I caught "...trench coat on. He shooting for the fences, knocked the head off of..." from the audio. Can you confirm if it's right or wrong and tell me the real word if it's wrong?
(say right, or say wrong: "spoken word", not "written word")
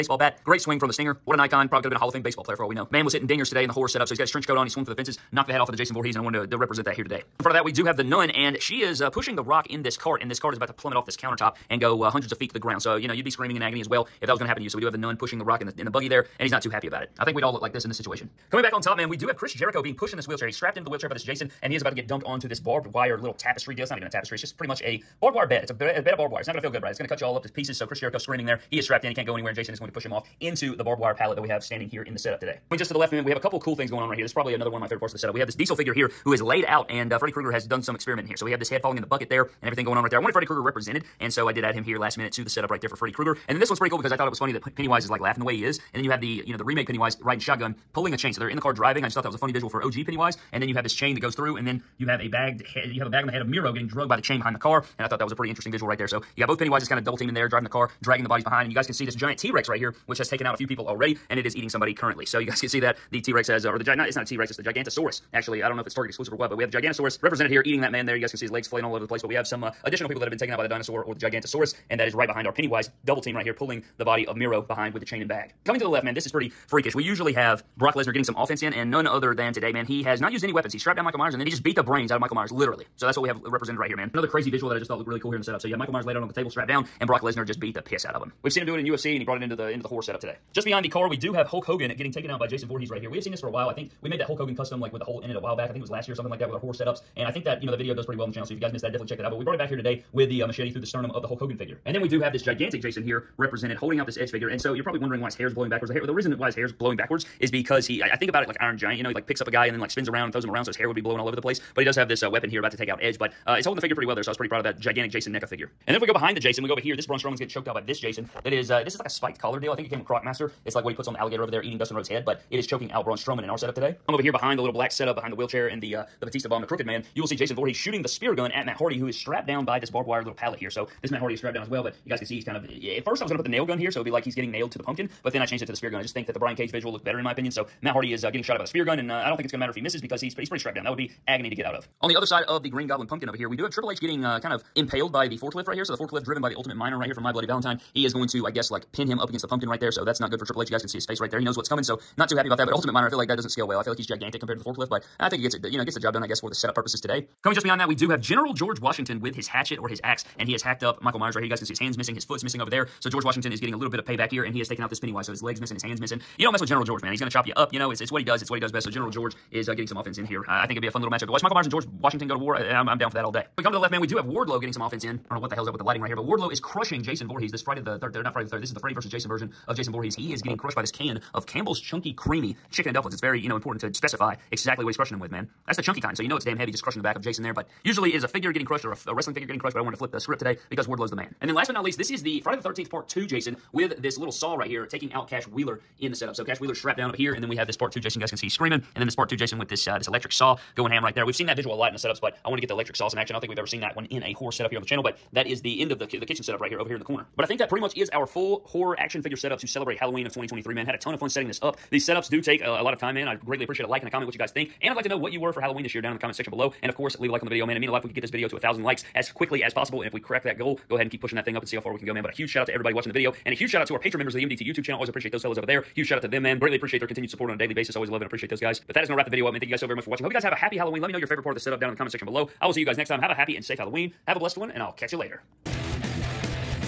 wrong: "swung", not "shooting".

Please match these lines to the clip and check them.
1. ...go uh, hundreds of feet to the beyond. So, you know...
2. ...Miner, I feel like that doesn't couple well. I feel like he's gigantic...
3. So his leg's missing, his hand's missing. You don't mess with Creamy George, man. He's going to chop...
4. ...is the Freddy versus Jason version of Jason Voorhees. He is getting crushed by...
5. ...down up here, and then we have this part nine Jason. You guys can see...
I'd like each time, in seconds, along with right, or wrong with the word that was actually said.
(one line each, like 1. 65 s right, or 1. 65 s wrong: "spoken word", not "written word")
1. 11 s wrong: "ground", not "beyond"
2. 152 s wrong: "scale", not "couple"
3. 165 s wrong: "General", not "Creamy"
4. 178 s right
5. 196 s wrong: "two", not "nine".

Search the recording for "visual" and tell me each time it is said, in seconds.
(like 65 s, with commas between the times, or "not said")
49 s, 55 s, 84 s, 136 s, 201 s.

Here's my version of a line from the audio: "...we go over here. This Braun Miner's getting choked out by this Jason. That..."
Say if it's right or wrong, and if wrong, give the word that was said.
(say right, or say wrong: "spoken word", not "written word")
wrong: "Strowman", not "Miner".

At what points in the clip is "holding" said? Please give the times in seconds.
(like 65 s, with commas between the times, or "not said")
103 s, 113 s.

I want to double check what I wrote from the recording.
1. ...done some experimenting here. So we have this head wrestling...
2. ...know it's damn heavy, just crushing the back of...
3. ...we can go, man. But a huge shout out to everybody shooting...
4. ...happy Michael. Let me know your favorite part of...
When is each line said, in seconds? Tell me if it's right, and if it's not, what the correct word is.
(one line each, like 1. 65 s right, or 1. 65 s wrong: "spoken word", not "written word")
1. 37 s wrong: "falling", not "wrestling"
2. 186 s right
3. 221 s wrong: "watching", not "shooting"
4. 230 s wrong: "Halloween", not "Michael".